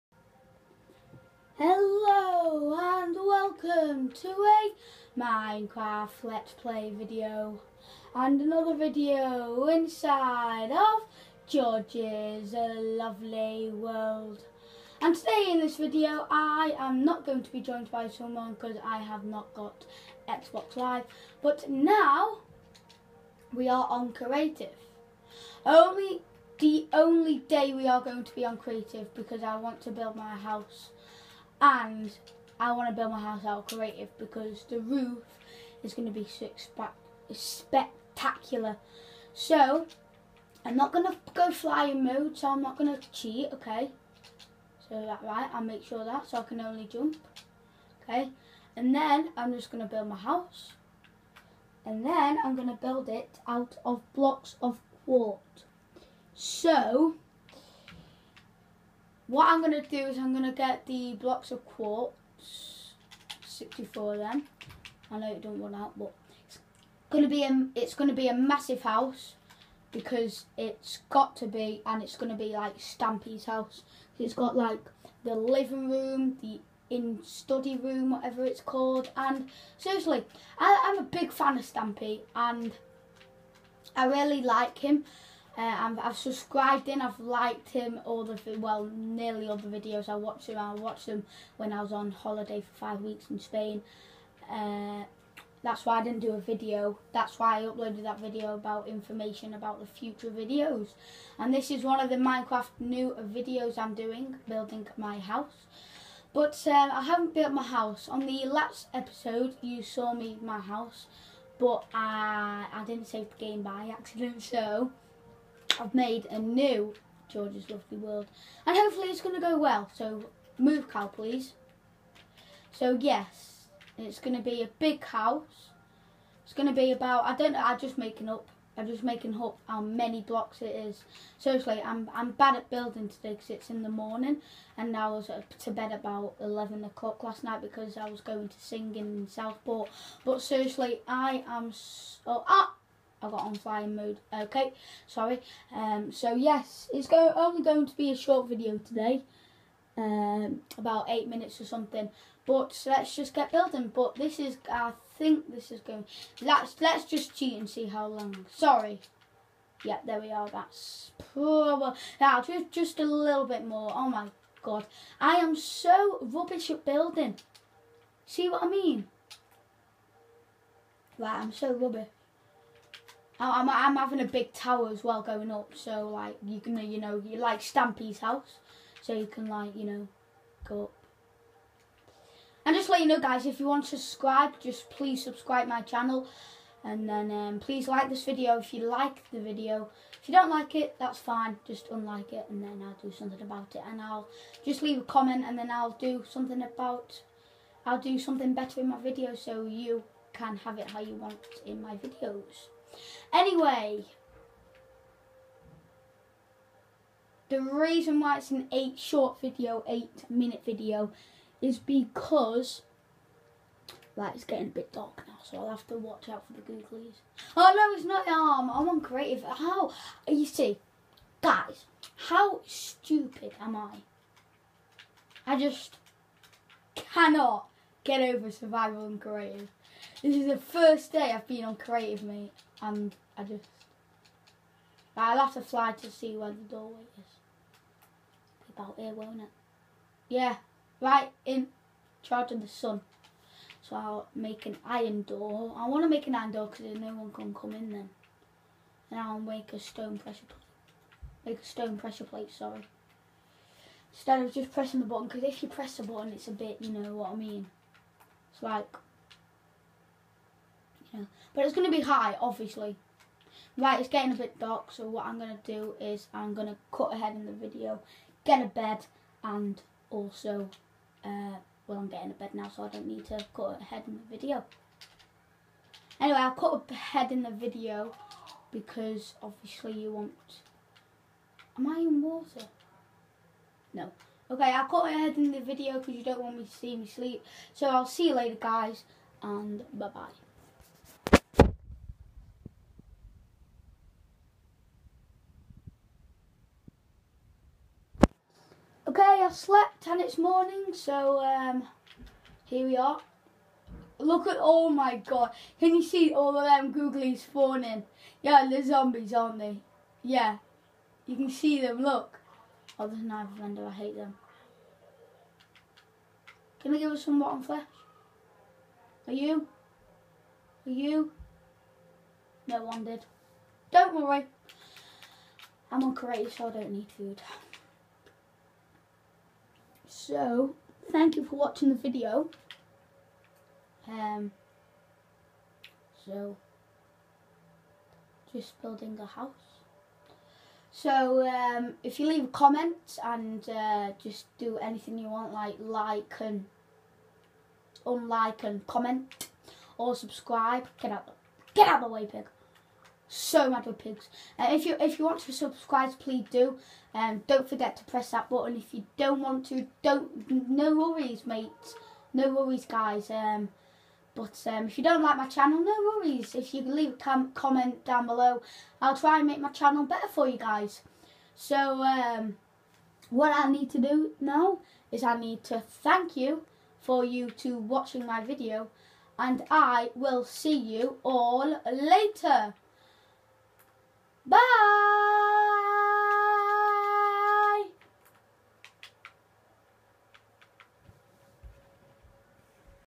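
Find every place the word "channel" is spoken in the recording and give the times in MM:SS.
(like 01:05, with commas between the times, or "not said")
03:05, 06:05, 06:09.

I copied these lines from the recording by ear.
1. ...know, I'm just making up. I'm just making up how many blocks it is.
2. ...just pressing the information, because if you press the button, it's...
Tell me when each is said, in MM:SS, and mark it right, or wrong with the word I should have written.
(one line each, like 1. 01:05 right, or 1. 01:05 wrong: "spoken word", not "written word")
1. 02:07 right
2. 04:14 wrong: "button", not "information".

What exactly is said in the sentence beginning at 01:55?
I've made a new George's Lovely World.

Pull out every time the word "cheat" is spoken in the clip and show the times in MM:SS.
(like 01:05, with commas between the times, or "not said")
00:43, 02:37.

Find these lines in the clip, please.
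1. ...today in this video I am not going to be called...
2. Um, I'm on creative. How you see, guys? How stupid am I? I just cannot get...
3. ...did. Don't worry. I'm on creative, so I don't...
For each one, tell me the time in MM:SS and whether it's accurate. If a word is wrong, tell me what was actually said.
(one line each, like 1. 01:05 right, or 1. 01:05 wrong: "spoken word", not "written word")
1. 00:15 wrong: "joined", not "called"
2. 03:38 right
3. 05:23 right.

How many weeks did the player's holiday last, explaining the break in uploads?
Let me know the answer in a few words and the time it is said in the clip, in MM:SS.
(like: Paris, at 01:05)
5, at 01:32.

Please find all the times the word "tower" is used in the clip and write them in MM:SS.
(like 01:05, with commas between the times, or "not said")
02:54.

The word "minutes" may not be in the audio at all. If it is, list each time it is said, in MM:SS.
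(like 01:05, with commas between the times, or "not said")
02:31, 03:30.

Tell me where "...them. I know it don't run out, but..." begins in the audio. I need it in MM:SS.
01:04.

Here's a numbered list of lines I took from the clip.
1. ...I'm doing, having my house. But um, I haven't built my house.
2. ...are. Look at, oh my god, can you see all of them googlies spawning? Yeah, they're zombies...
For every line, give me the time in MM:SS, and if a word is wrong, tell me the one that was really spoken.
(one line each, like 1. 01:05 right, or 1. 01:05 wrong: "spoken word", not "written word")
1. 01:43 wrong: "building", not "having"
2. 05:02 right.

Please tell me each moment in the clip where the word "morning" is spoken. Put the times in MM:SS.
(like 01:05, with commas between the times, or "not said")
02:13, 05:00.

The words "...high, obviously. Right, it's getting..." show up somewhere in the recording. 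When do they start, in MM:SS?
04:22.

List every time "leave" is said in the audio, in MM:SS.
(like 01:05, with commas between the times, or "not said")
03:14, 05:42, 06:06.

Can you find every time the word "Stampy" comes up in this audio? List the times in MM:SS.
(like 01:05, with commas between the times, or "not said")
01:12, 01:21, 02:57.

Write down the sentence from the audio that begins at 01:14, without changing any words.
It's got like the living room, the in study room, whatever it's called.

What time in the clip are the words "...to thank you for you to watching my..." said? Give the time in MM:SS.
06:15.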